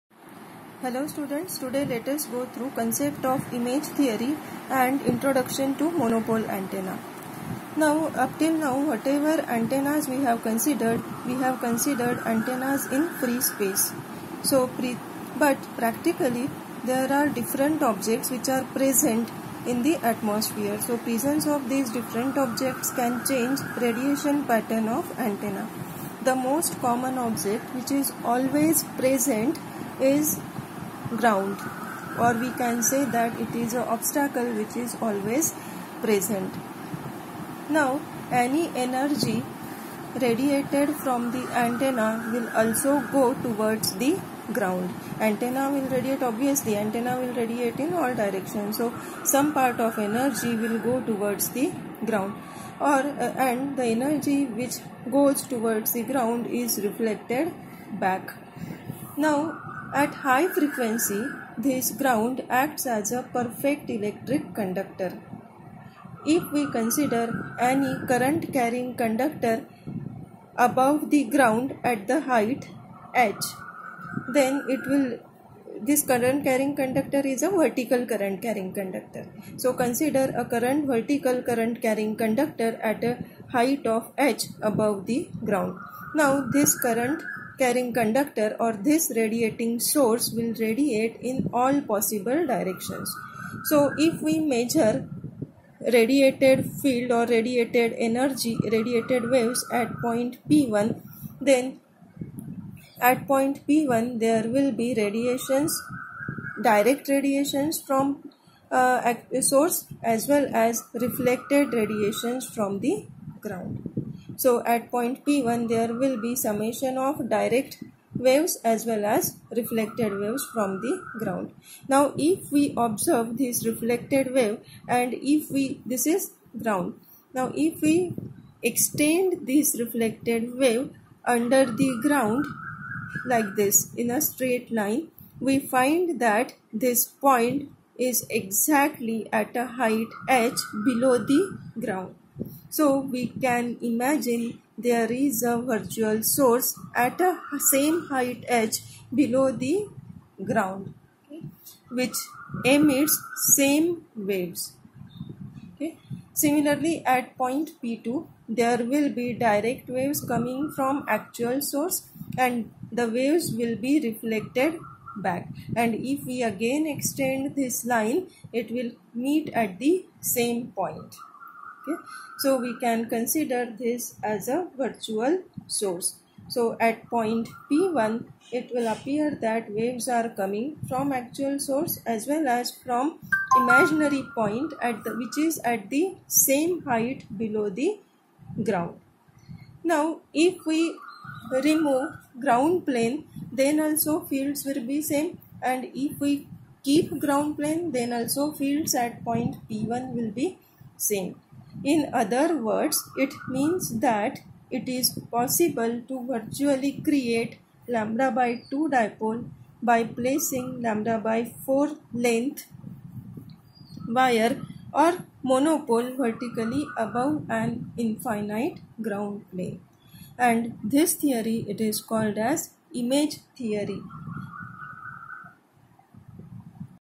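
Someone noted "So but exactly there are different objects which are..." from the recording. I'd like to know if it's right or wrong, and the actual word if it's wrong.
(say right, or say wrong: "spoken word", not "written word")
wrong: "practically", not "exactly".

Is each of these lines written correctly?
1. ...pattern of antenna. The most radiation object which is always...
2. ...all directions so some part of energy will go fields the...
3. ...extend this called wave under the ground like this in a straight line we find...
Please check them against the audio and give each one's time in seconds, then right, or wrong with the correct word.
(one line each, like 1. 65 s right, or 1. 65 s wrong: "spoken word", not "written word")
1. 24 s wrong: "common", not "radiation"
2. 47 s wrong: "towards", not "fields"
3. 128 s wrong: "reflected", not "called".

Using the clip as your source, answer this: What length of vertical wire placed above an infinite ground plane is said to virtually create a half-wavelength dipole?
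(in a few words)
lambda/4.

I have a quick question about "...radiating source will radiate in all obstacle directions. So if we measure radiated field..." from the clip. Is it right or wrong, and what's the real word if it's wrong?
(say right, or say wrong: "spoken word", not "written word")
wrong: "possible", not "obstacle".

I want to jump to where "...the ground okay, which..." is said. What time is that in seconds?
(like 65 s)
149 s.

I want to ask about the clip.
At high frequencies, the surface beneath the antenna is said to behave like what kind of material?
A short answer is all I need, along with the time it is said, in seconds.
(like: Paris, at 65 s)
perfect electric conductor, at 63 s.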